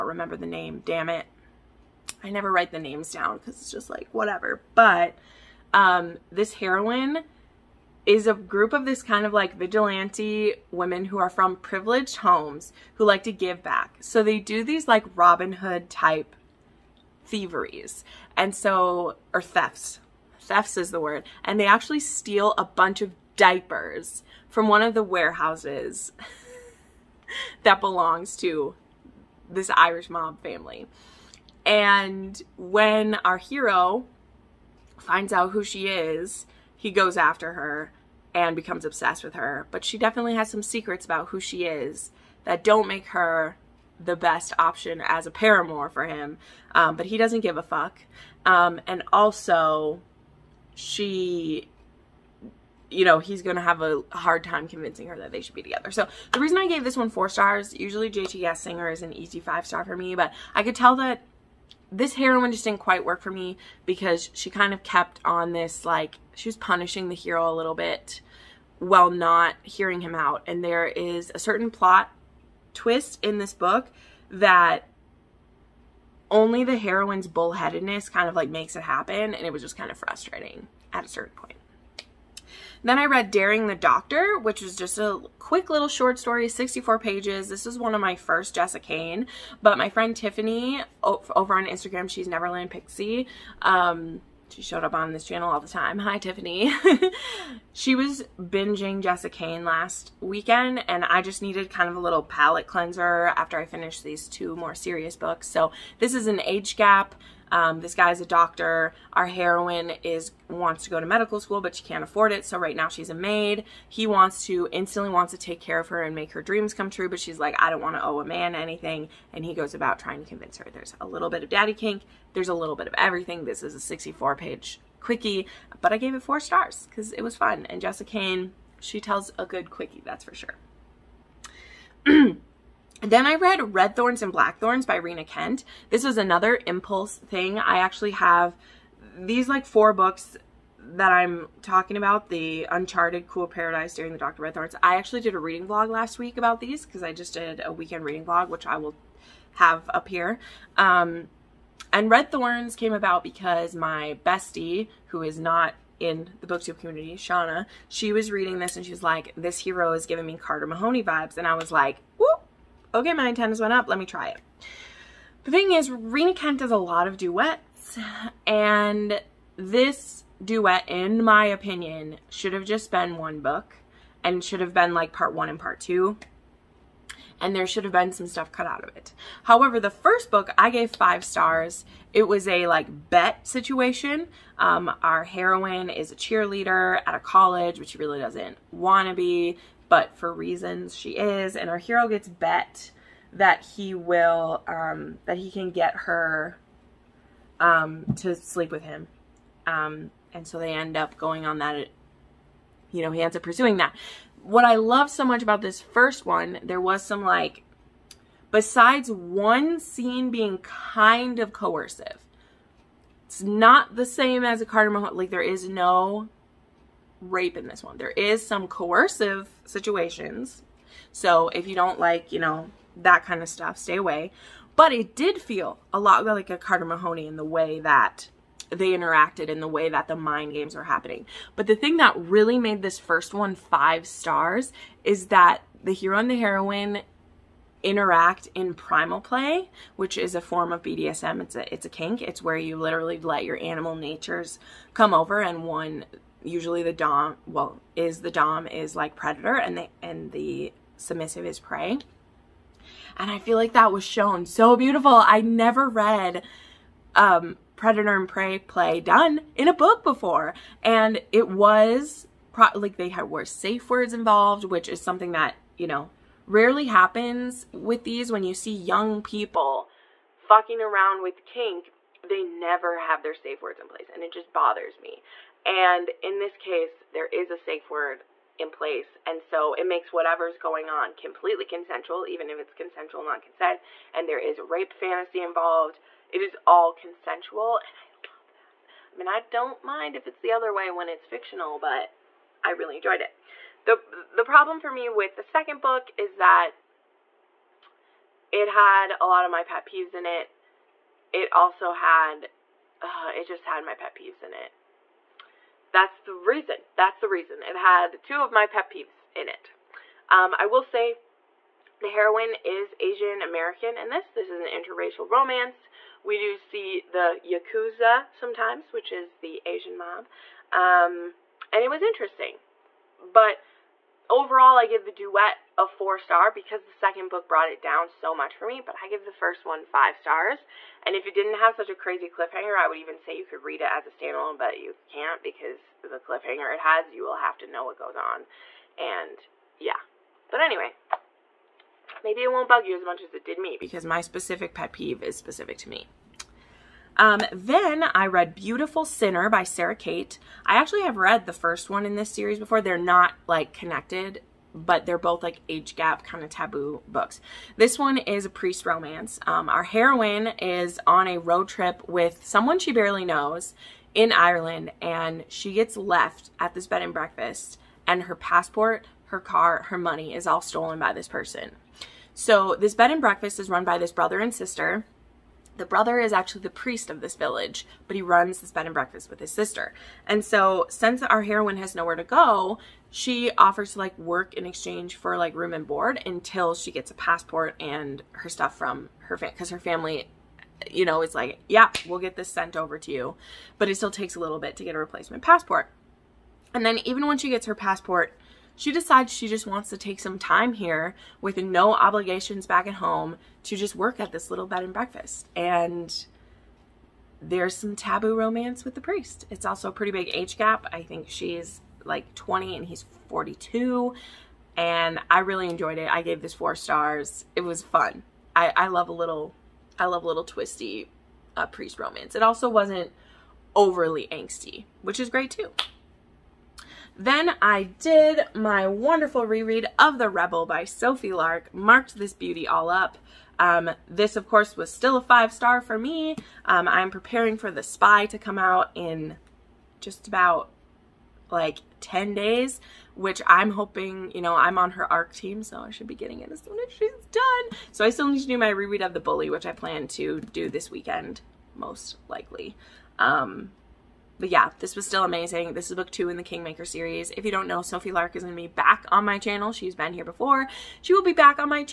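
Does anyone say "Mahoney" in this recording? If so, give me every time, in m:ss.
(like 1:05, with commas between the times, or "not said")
2:40, 3:46.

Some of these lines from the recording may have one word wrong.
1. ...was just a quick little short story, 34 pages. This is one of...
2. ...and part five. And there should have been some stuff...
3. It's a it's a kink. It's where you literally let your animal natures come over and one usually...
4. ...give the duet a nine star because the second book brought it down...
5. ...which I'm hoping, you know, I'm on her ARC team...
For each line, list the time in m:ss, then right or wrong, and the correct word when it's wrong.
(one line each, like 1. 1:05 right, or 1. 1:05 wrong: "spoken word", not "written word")
1. 1:24 wrong: "64", not "34"
2. 2:55 wrong: "two", not "five"
3. 4:01 right
4. 5:24 wrong: "four", not "nine"
5. 7:23 right.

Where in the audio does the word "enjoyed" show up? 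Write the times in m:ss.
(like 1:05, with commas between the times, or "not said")
4:52, 6:55.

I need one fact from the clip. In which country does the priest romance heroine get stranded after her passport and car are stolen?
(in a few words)
Ireland.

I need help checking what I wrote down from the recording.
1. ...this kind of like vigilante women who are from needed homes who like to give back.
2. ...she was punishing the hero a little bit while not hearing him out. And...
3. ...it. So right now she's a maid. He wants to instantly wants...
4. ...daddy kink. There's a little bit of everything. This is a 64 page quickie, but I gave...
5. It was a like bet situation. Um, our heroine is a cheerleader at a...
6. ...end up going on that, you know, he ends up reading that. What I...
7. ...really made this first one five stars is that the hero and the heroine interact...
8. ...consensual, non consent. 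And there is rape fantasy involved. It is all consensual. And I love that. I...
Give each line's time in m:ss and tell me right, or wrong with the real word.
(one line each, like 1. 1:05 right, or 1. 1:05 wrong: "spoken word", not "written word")
1. 0:08 wrong: "privileged", not "needed"
2. 1:06 right
3. 1:52 right
4. 2:01 right
5. 3:02 right
6. 3:20 wrong: "pursuing", not "reading"
7. 3:52 right
8. 4:42 right.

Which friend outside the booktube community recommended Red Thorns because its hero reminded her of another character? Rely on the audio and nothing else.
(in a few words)
Shauna.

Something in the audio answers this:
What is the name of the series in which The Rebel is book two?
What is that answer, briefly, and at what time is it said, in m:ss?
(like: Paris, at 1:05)
Kingmaker, at 7:36.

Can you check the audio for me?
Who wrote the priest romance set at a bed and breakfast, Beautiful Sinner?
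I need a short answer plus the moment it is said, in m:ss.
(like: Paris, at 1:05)
Sara Cate, at 5:49.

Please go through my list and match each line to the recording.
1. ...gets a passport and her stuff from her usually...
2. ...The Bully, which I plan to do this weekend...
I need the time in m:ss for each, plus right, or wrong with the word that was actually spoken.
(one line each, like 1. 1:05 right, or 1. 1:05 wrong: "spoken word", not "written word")
1. 6:26 wrong: "family", not "usually"
2. 7:29 right.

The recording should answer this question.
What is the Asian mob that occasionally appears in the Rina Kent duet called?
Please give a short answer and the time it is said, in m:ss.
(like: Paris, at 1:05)
Yakuza, at 5:17.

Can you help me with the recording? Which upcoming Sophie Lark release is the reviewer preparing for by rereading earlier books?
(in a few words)
The Spy.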